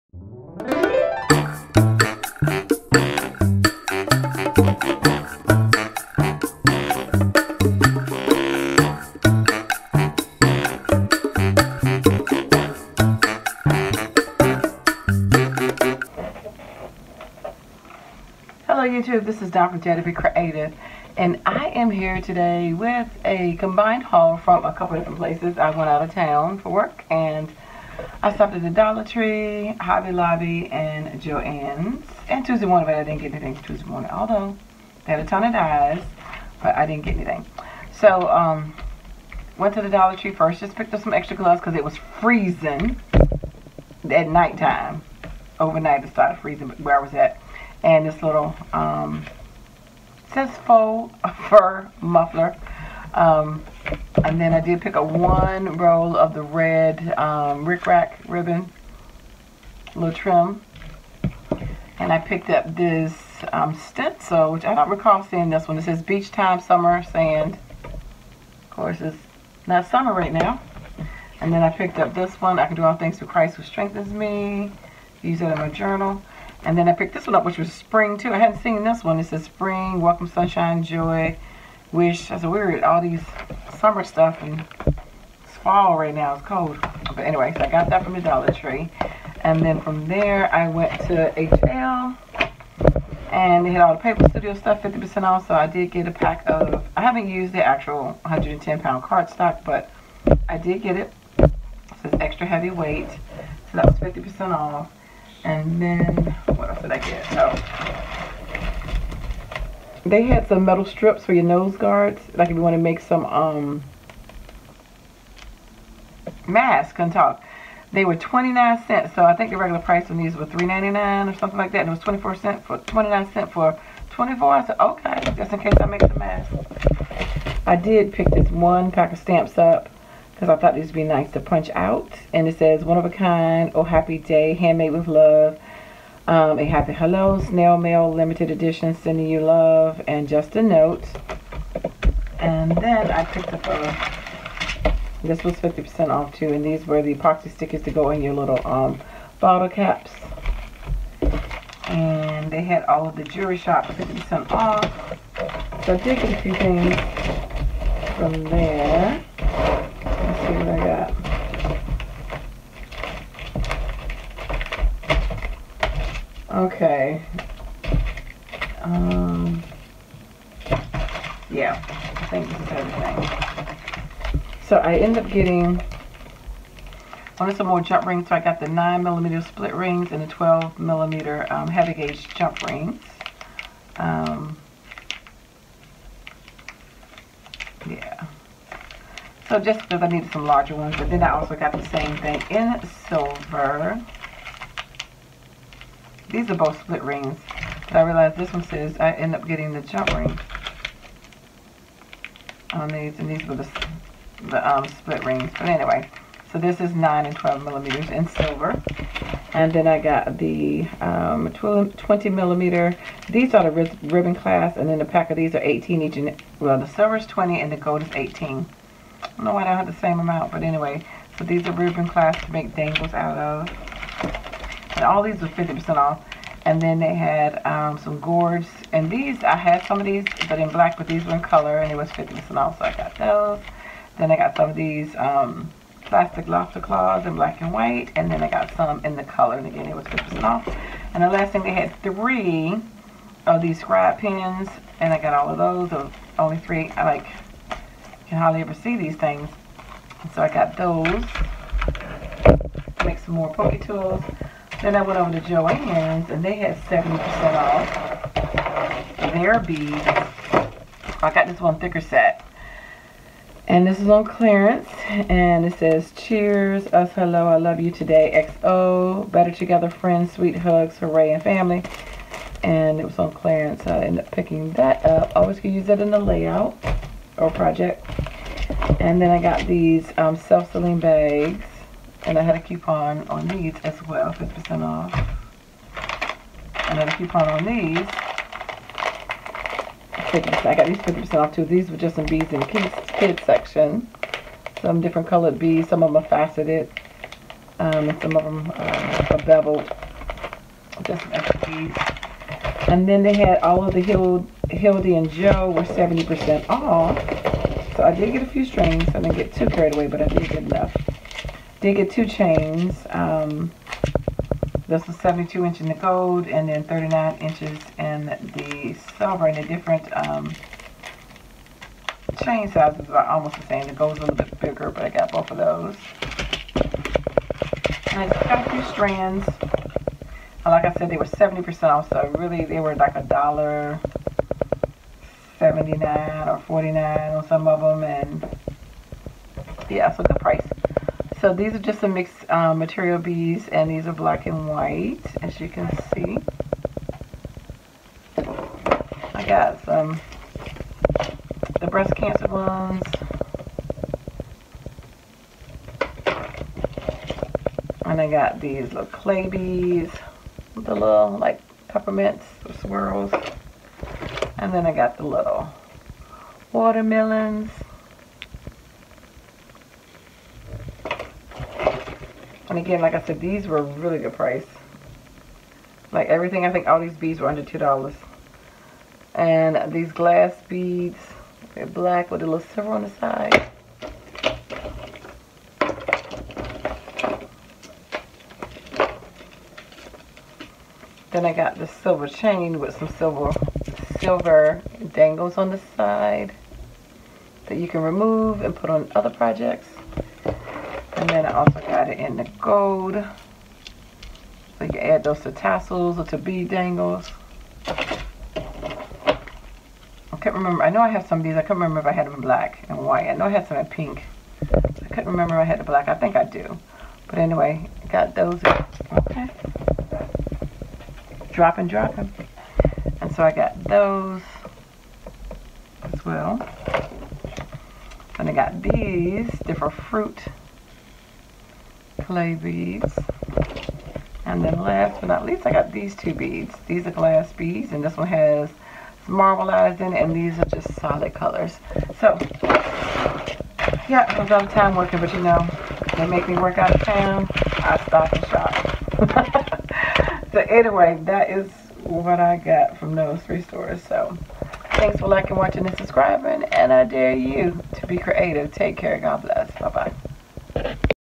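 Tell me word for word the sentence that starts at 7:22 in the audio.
So, yeah, I was out of time working, but you know, they make me work out of town, I stop and shop.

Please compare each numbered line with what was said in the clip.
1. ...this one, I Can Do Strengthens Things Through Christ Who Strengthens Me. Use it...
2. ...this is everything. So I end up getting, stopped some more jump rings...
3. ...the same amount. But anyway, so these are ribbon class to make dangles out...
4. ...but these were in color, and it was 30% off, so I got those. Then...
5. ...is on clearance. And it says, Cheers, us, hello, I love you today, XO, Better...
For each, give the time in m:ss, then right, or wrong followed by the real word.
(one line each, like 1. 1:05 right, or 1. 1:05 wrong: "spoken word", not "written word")
1. 1:12 wrong: "All", not "Strengthens"
2. 2:52 wrong: "wanted", not "stopped"
3. 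3:39 right
4. 3:50 wrong: "50", not "30"
5. 4:23 right.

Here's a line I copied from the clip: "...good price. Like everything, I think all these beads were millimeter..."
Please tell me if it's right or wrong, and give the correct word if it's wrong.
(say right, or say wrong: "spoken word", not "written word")
wrong: "under", not "millimeter".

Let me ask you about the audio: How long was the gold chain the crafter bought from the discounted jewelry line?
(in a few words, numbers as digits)
72 inches.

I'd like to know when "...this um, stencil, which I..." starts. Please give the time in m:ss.
1:02.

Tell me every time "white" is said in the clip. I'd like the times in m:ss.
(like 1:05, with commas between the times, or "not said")
3:57, 5:44, 6:52.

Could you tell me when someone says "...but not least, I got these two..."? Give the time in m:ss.
7:15.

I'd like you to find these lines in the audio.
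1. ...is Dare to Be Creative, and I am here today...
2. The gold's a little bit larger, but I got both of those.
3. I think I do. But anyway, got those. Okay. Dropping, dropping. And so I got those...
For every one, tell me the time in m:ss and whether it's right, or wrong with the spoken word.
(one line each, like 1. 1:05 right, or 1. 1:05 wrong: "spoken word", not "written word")
1. 0:19 right
2. 5:23 wrong: "bigger", not "larger"
3. 6:56 right.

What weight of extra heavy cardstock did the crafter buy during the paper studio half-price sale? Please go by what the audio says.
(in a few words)
110 pound.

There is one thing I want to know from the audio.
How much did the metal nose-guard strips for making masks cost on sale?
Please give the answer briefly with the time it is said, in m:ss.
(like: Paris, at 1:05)
29 cents, at 1:58.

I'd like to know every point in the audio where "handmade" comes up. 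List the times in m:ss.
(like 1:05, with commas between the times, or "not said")
2:14.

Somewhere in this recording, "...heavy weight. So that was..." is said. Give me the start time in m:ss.
1:42.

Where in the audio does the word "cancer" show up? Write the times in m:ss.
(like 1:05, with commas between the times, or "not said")
5:52.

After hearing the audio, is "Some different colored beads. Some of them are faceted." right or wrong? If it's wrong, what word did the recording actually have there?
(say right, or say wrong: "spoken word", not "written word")
right.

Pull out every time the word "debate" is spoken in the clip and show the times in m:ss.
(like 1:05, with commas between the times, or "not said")
not said.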